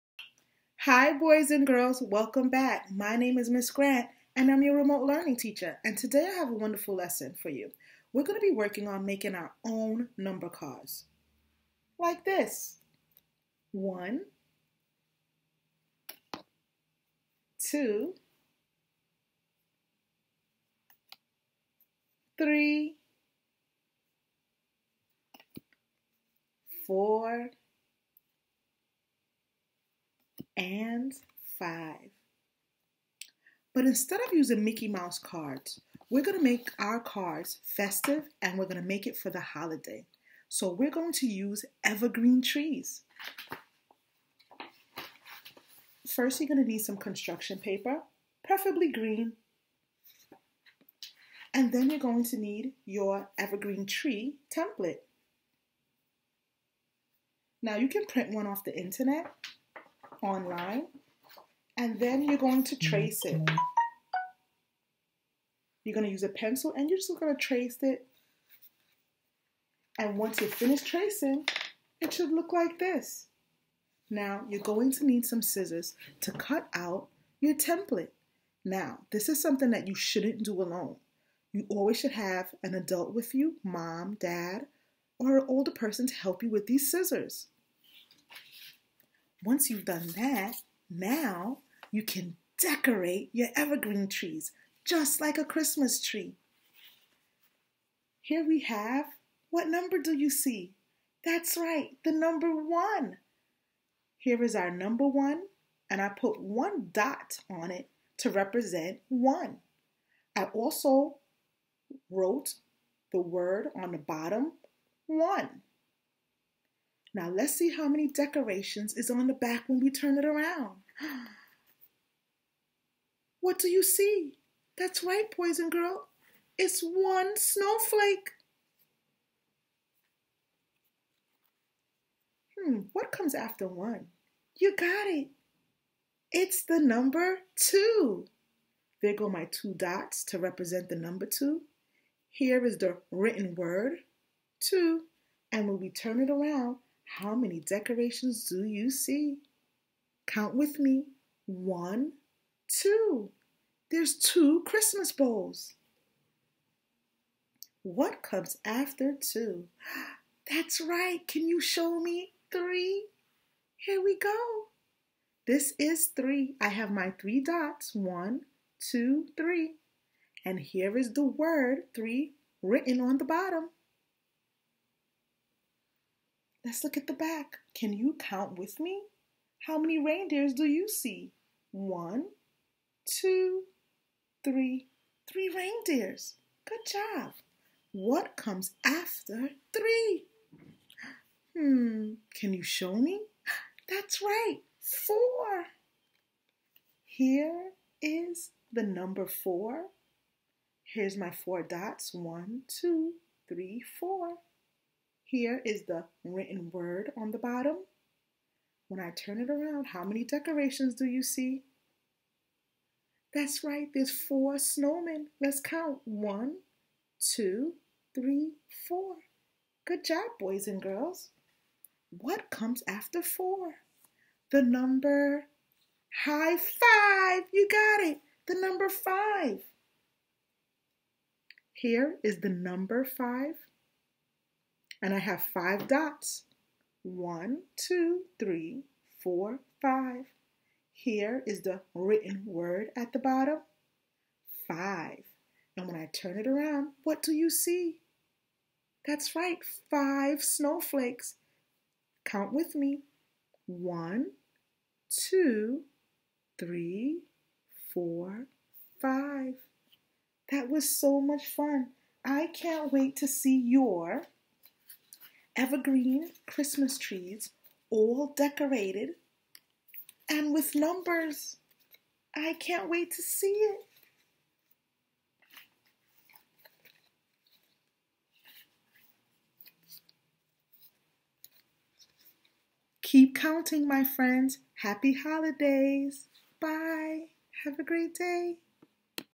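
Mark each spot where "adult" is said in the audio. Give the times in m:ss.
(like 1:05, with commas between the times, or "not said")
1:22.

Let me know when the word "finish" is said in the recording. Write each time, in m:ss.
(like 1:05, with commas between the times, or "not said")
1:10.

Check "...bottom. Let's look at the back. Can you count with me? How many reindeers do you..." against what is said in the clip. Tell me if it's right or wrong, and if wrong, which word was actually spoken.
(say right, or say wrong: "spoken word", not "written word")
right.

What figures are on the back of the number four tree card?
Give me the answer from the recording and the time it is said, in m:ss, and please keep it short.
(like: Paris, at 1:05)
Snowmen, at 3:34.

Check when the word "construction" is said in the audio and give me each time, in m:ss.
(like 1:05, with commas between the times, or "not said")
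0:46.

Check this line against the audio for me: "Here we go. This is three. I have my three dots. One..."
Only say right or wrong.
right.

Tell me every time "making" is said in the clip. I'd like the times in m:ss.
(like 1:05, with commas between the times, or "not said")
0:09.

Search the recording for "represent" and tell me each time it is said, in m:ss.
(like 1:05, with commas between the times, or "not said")
1:48, 2:20.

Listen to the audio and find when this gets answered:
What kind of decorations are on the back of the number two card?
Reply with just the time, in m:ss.
2:34.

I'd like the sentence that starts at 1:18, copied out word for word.
Now, this is something that you shouldn't do alone.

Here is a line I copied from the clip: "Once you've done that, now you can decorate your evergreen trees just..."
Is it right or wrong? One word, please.
right.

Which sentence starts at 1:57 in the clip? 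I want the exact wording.
Now let's see how many decorations is on the back when we turn it around.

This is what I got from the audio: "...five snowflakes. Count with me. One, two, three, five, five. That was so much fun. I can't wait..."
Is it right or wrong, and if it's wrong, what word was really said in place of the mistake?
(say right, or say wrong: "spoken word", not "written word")
wrong: "four", not "five".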